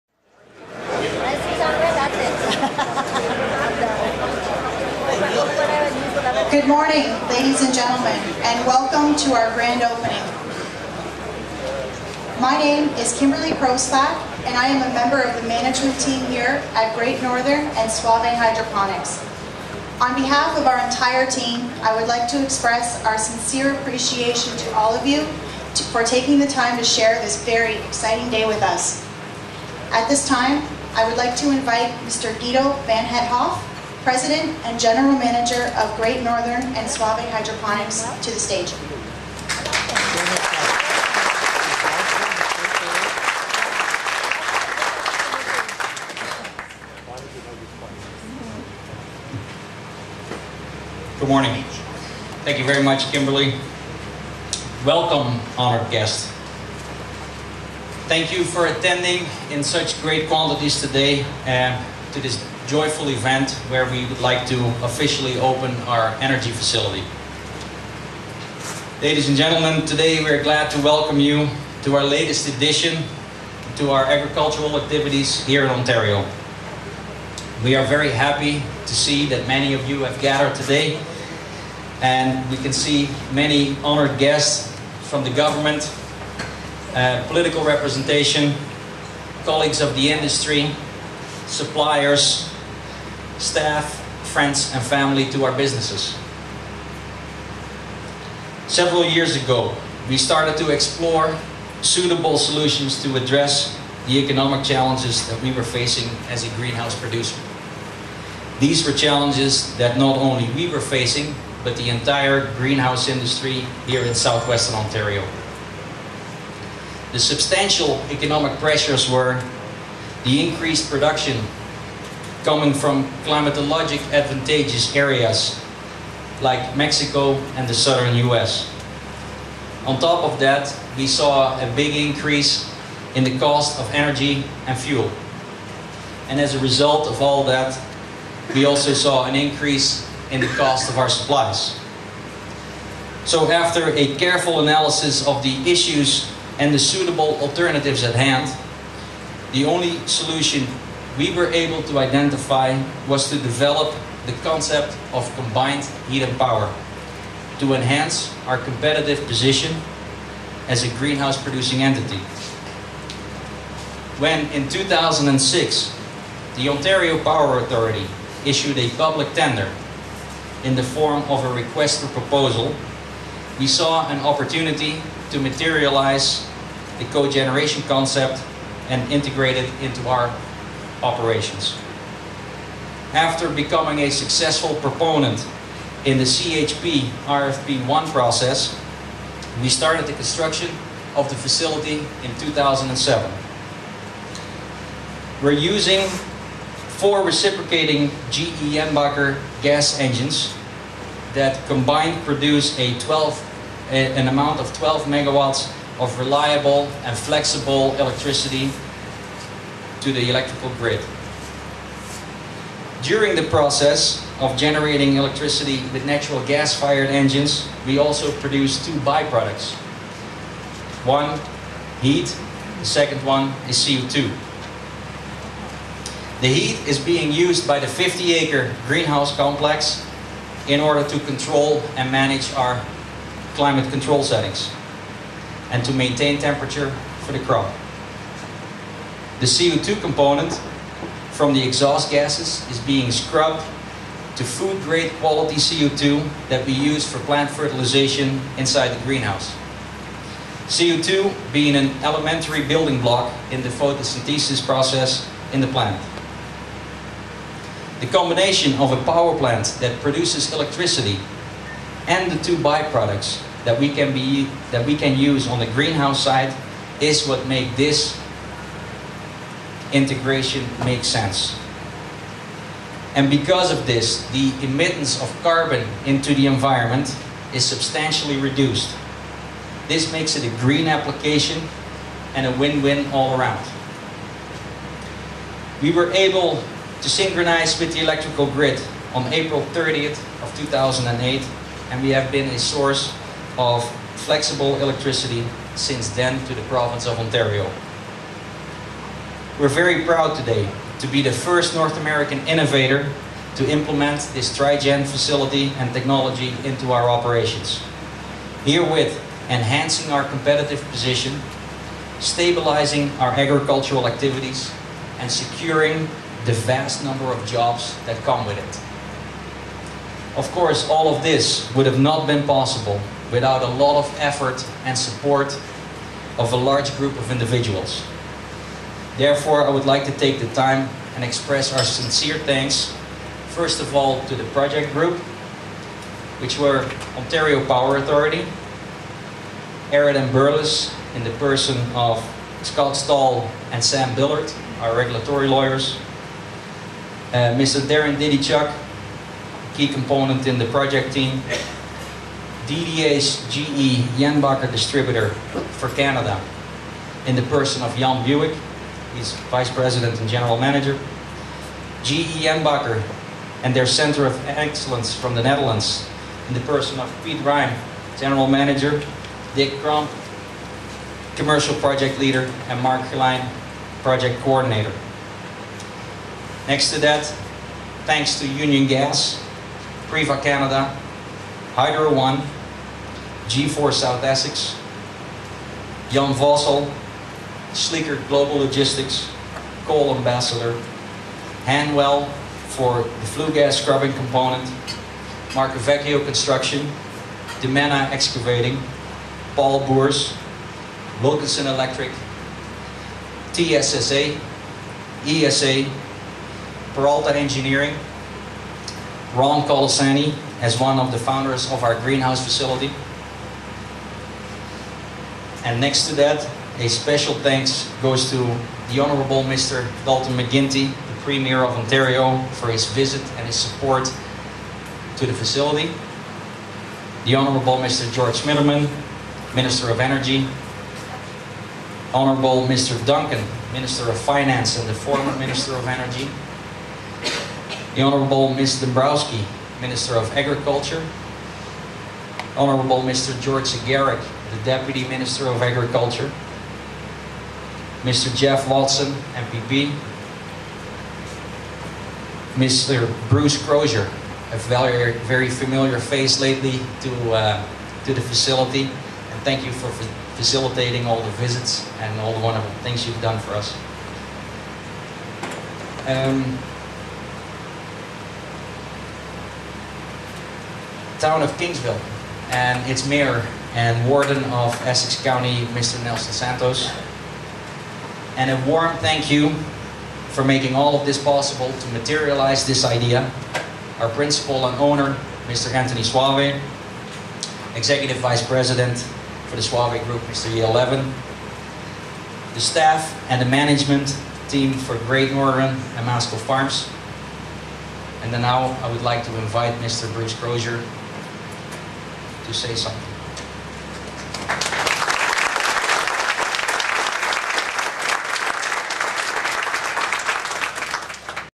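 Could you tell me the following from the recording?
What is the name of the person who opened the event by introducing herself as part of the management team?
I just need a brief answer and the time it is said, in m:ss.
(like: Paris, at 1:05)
Kimberley Kroslak, at 0:13.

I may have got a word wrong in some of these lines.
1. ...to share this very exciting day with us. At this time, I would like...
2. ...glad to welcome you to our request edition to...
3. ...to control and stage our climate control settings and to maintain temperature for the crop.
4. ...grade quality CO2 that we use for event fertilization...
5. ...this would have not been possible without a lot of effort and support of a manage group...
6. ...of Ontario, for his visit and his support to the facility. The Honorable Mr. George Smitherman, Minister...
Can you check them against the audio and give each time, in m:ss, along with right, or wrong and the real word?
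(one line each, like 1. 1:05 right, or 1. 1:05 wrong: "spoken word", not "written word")
1. 0:26 right
2. 1:10 wrong: "latest", not "request"
3. 3:51 wrong: "manage", not "stage"
4. 4:04 wrong: "plant", not "event"
5. 5:21 wrong: "large", not "manage"
6. 7:01 right.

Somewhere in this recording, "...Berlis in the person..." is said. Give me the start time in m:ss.
5:40.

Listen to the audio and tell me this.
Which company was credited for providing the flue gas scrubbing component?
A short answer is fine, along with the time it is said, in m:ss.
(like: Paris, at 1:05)
Hanwell, at 6:31.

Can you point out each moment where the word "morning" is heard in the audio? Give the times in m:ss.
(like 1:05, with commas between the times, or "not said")
0:06, 0:51.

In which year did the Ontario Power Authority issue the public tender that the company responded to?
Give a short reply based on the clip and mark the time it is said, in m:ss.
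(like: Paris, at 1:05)
2006, at 2:44.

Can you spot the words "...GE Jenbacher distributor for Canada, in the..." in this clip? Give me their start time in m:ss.
5:53.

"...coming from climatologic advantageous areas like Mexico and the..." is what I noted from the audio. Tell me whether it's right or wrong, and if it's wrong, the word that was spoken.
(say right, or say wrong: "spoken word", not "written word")
right.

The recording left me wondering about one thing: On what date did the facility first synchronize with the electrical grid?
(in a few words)
April 30, 2008.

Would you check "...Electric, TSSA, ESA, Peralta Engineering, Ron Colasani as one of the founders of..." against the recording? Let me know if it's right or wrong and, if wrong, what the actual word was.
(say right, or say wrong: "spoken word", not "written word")
right.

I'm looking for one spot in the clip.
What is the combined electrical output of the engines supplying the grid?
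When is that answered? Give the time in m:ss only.
3:24.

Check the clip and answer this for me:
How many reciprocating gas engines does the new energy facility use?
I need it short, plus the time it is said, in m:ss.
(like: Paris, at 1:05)
4, at 3:16.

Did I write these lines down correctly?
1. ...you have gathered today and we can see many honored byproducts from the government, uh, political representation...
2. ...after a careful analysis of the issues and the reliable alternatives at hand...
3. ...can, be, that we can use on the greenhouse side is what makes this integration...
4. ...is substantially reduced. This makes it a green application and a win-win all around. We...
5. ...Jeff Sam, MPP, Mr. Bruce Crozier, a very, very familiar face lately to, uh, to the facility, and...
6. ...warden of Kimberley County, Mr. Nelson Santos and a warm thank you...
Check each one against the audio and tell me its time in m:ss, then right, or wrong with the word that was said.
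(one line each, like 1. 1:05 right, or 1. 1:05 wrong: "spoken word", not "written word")
1. 1:19 wrong: "guests", not "byproducts"
2. 2:23 wrong: "suitable", not "reliable"
3. 4:23 right
4. 4:37 right
5. 7:28 wrong: "Watson", not "Sam"
6. 7:54 wrong: "Essex", not "Kimberley".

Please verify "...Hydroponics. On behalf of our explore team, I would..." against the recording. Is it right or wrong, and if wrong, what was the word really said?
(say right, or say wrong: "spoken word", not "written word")
wrong: "entire", not "explore".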